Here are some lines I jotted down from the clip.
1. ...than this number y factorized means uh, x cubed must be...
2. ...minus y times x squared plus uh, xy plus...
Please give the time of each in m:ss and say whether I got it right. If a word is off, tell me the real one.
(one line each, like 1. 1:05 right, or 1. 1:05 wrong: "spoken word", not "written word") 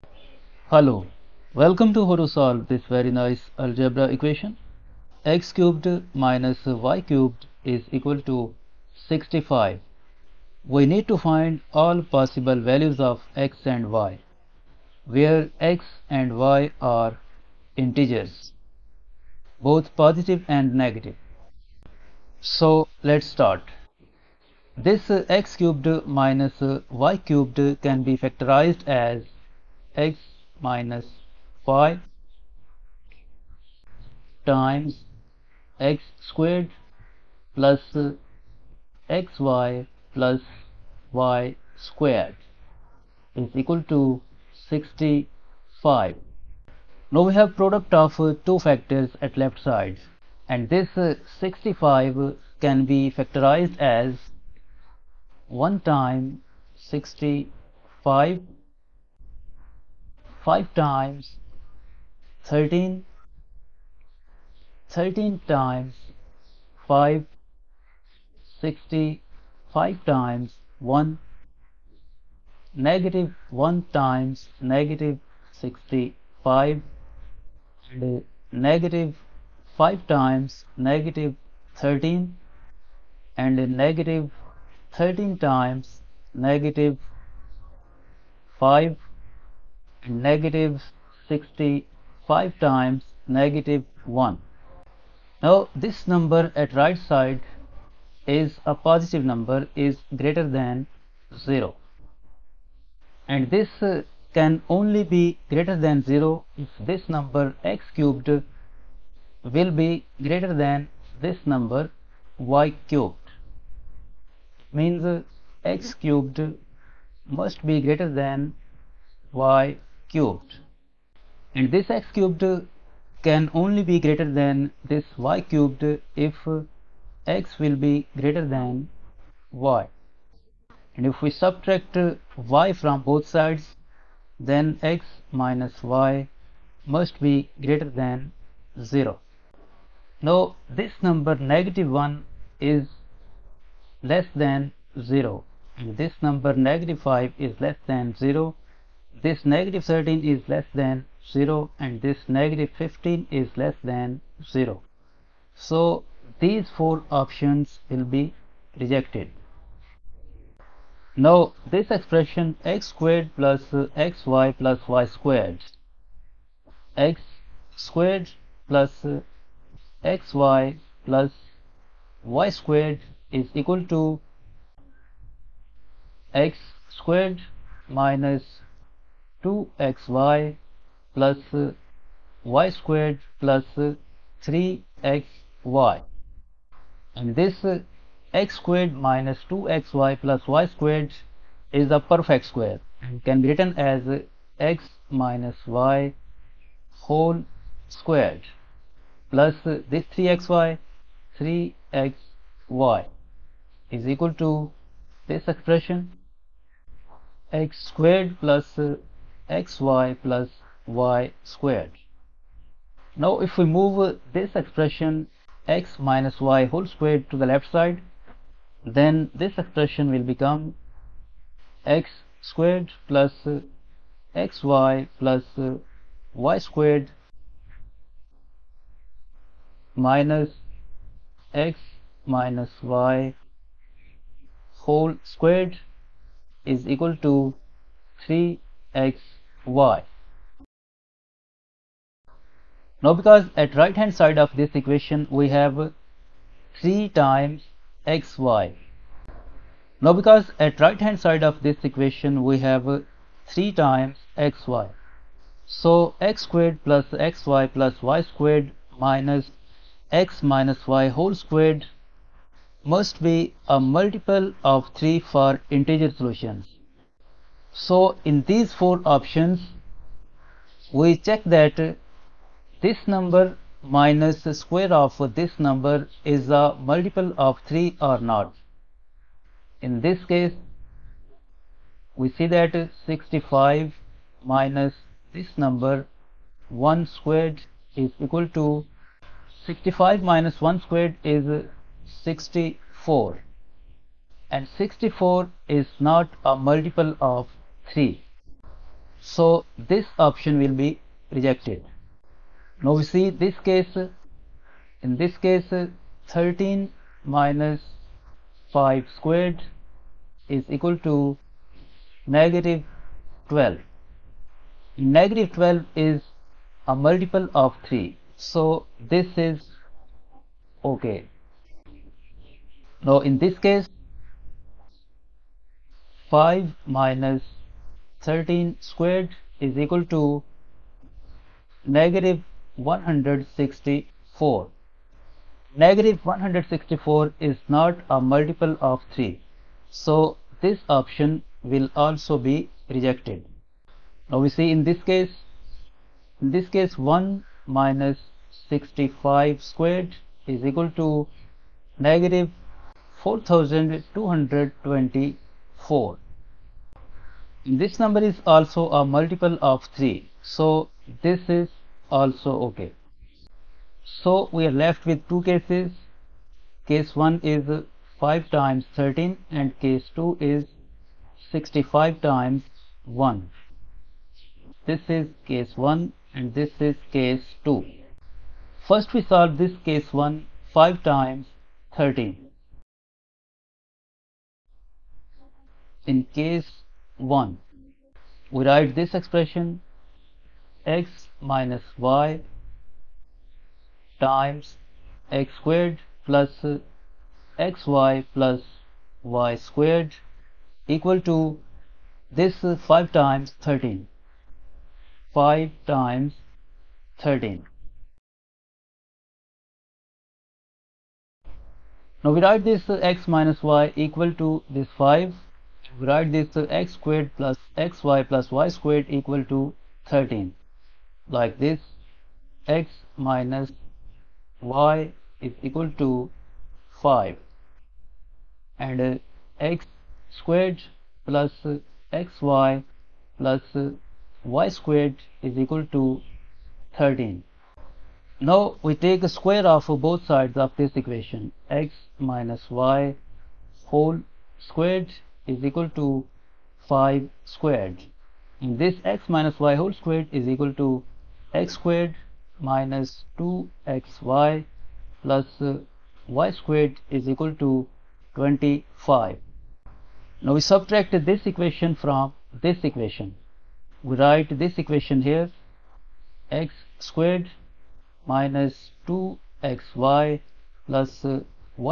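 1. 1:50 wrong: "cubed", not "factorized"
2. 6:31 right.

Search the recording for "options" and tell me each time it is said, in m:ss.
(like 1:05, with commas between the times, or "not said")
2:37, 4:29, 5:00, 5:40.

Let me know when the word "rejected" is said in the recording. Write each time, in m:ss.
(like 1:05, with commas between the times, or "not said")
2:38, 5:01, 5:42.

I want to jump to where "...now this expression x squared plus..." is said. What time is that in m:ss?
2:41.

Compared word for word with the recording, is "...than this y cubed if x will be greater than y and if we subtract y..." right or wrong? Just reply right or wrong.
right.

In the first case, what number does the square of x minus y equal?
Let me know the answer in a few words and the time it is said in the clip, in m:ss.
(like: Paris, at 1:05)
25, at 7:38.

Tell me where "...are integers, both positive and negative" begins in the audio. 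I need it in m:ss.
0:16.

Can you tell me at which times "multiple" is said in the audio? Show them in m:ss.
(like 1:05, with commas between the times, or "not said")
4:23, 4:36, 4:56, 5:17, 5:38, 5:59.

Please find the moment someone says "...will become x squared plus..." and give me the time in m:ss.
3:40.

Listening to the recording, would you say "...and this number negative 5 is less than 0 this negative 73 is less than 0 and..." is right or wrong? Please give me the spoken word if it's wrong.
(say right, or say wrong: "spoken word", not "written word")
wrong: "13", not "73".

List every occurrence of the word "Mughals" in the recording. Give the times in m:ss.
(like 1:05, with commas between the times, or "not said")
not said.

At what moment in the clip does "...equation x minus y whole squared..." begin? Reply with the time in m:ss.
7:21.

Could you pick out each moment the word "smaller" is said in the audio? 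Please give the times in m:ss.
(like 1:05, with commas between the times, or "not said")
not said.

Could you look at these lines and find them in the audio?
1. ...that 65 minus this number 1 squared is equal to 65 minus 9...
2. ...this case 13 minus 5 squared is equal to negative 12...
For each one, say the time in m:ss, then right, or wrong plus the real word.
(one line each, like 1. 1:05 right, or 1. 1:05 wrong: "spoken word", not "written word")
1. 4:42 wrong: "1", not "9"
2. 5:05 right.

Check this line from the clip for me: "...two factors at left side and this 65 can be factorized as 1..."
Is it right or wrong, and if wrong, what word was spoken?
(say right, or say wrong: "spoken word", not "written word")
right.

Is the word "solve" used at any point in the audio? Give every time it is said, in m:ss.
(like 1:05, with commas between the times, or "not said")
0:02, 6:19.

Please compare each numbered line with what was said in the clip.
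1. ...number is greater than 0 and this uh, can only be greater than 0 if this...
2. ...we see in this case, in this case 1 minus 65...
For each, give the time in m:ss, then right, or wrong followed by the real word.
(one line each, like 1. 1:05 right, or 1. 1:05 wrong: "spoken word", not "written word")
1. 1:39 right
2. 5:44 right.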